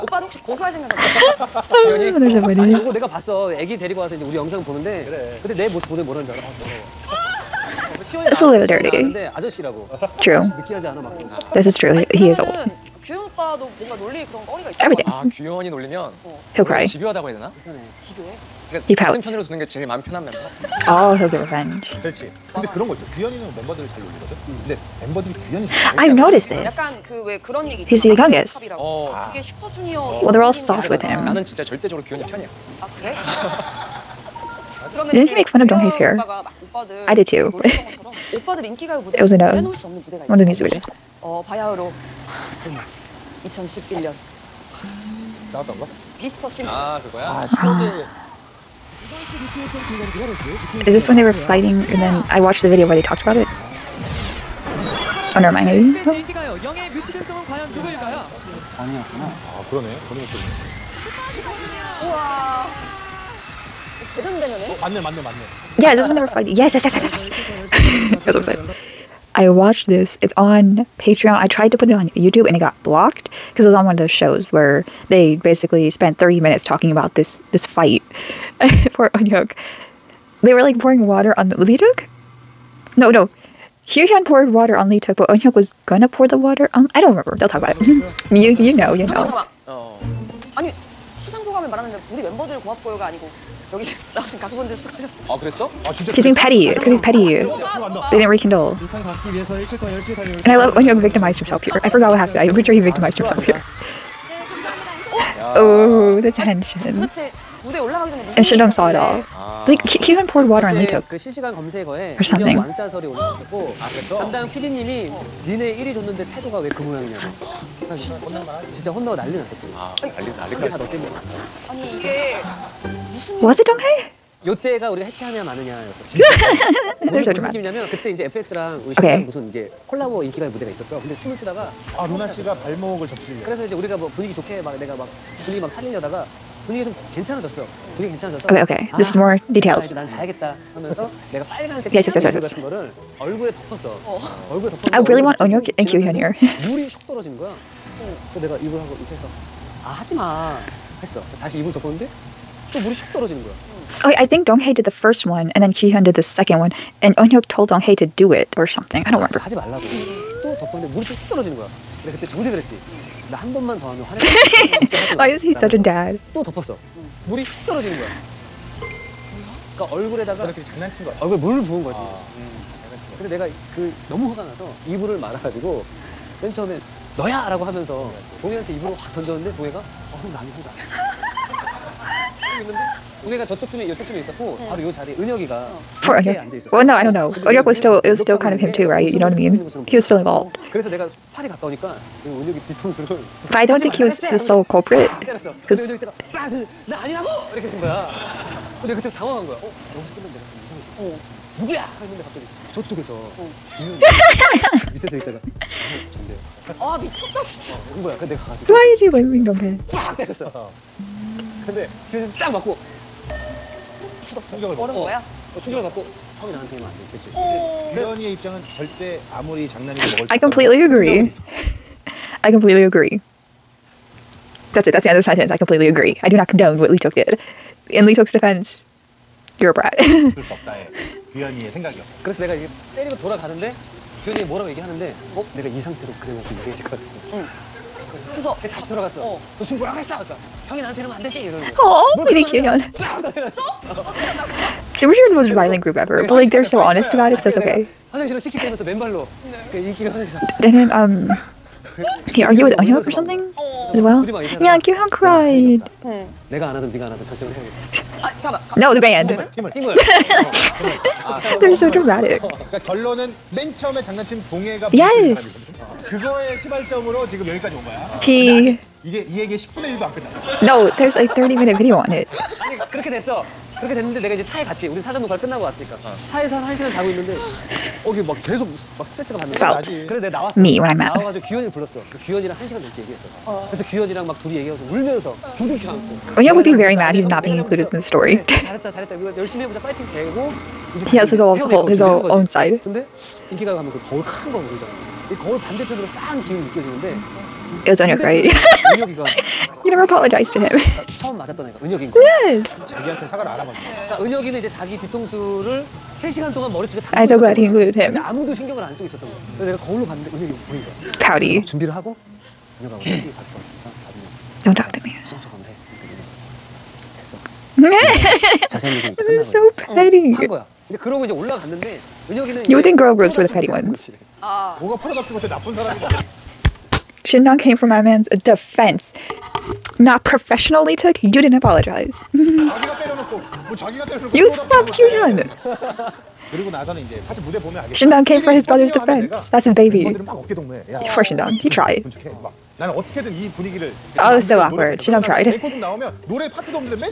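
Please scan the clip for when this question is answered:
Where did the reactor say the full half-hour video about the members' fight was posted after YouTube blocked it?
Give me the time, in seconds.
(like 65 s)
70 s.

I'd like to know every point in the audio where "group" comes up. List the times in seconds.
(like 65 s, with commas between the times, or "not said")
245 s, 323 s.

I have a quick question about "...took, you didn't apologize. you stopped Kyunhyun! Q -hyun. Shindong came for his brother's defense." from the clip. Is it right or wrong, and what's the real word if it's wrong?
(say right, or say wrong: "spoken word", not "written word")
right.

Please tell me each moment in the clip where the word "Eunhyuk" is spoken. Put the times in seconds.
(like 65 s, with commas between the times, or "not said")
79 s, 85 s, 157 s, 252 s.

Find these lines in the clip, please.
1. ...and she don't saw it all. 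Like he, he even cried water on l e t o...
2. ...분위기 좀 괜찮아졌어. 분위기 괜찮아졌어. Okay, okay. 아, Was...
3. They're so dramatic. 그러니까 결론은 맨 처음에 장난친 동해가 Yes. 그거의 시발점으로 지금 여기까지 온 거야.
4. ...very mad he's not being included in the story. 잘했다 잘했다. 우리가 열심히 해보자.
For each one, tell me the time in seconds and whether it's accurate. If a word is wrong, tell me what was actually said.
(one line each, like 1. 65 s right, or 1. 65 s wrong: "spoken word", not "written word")
1. 108 s wrong: "poured", not "cried"
2. 136 s wrong: "This", not "Was"
3. 261 s right
4. 286 s right.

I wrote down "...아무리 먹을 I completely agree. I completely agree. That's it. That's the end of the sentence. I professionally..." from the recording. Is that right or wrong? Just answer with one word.
wrong.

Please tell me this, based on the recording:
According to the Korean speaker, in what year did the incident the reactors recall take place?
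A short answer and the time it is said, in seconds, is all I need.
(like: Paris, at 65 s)
2011, at 43 s.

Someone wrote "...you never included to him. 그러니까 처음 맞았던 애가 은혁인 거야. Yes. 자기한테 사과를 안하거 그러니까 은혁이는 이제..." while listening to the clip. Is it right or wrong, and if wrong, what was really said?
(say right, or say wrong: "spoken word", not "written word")
wrong: "apologized", not "included".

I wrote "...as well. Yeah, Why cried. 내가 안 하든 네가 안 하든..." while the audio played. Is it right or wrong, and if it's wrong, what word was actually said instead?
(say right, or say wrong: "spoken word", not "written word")
wrong: "Kyuhyun", not "Why".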